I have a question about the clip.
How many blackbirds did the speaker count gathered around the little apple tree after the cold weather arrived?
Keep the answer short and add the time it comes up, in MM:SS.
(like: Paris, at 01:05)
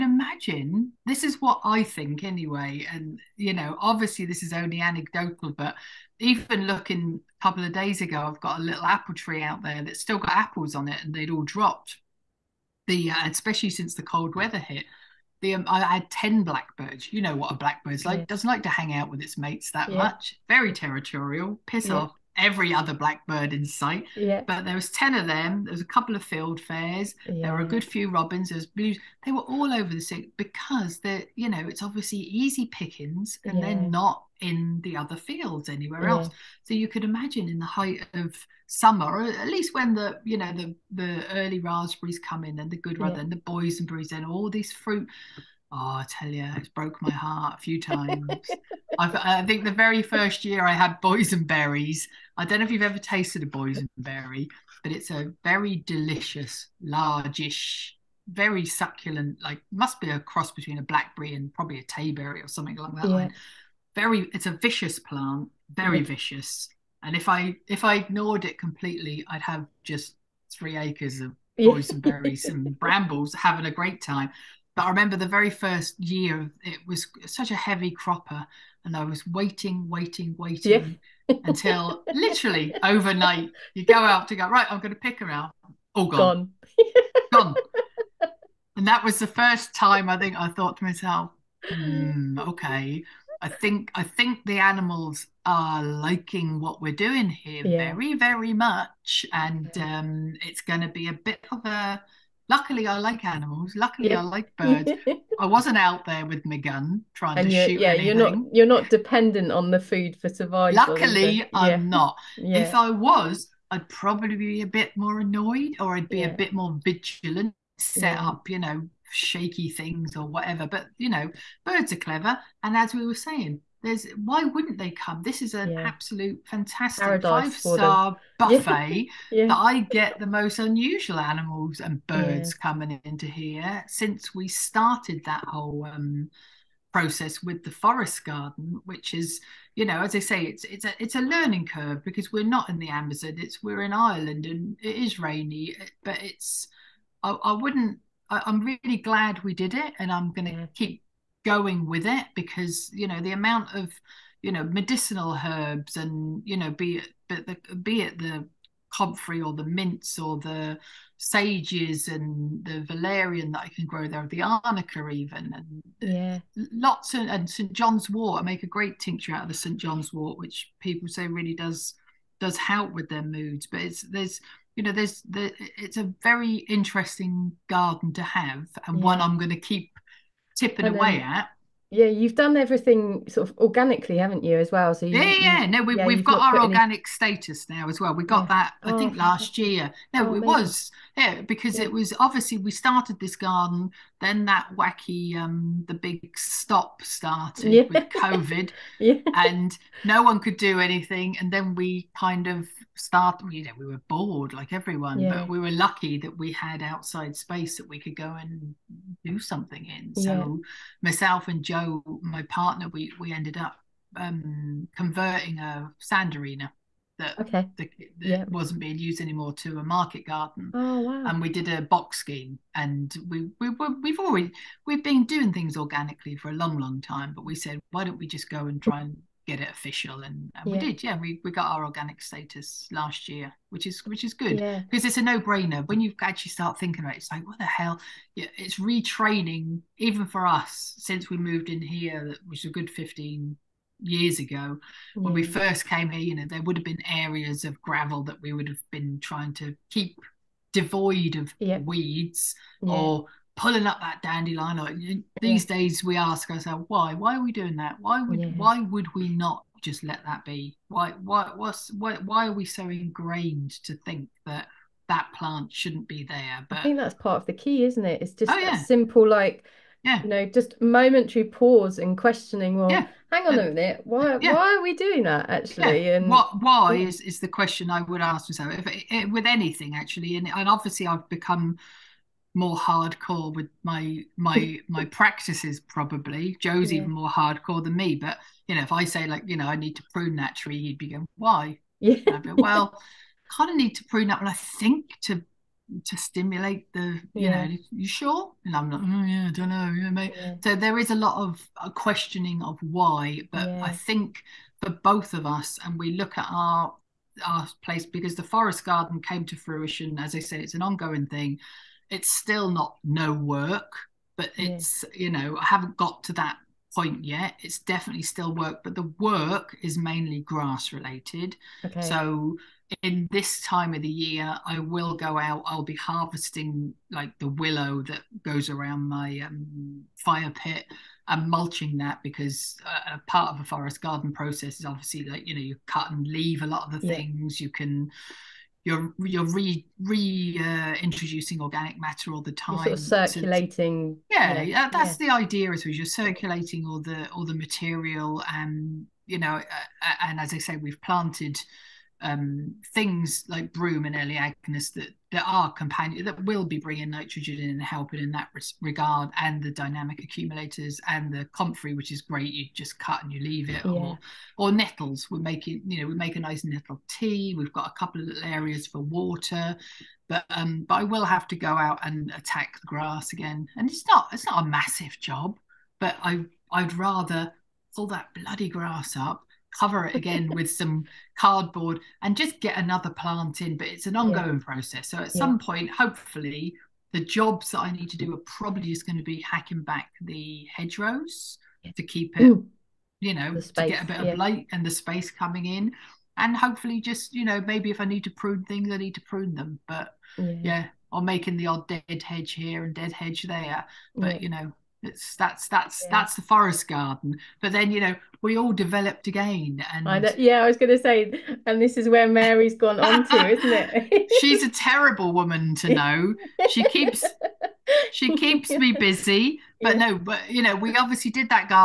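10, at 00:16.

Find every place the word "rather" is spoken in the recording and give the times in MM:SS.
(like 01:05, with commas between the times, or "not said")
00:42, 06:16.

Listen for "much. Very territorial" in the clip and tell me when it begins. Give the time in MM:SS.
00:19.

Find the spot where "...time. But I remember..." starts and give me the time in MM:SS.
01:14.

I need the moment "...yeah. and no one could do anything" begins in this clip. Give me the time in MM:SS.
03:18.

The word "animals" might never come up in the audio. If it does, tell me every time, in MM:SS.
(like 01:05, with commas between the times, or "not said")
01:34, 01:43, 02:11.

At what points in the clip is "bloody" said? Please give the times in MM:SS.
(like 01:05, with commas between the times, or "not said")
06:18.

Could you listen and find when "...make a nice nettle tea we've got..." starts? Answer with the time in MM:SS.
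06:06.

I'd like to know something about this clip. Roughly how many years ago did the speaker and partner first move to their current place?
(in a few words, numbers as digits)
15.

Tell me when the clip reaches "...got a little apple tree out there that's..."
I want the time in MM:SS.
00:08.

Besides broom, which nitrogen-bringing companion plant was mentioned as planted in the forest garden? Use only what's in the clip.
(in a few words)
Elaeagnus.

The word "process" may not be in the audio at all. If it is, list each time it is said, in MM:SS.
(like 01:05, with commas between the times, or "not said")
02:16, 05:34, 06:24.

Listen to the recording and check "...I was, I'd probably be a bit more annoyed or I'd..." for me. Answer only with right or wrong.
right.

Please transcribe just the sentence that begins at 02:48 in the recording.
I make a great tincture out of the St John's wort, which people say really does does help with their moods.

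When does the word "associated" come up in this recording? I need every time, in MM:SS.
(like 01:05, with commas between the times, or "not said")
not said.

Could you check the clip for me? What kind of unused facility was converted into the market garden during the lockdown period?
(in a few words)
A sand arena.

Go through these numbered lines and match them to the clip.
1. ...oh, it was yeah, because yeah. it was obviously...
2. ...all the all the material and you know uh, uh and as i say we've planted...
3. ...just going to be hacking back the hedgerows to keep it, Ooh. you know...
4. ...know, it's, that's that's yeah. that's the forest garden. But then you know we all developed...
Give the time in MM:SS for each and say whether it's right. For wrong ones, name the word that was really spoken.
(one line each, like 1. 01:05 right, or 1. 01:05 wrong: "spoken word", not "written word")
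1. 03:10 right
2. 05:46 right
3. 06:28 right
4. 06:44 right.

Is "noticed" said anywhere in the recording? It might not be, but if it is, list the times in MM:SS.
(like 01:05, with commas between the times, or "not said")
not said.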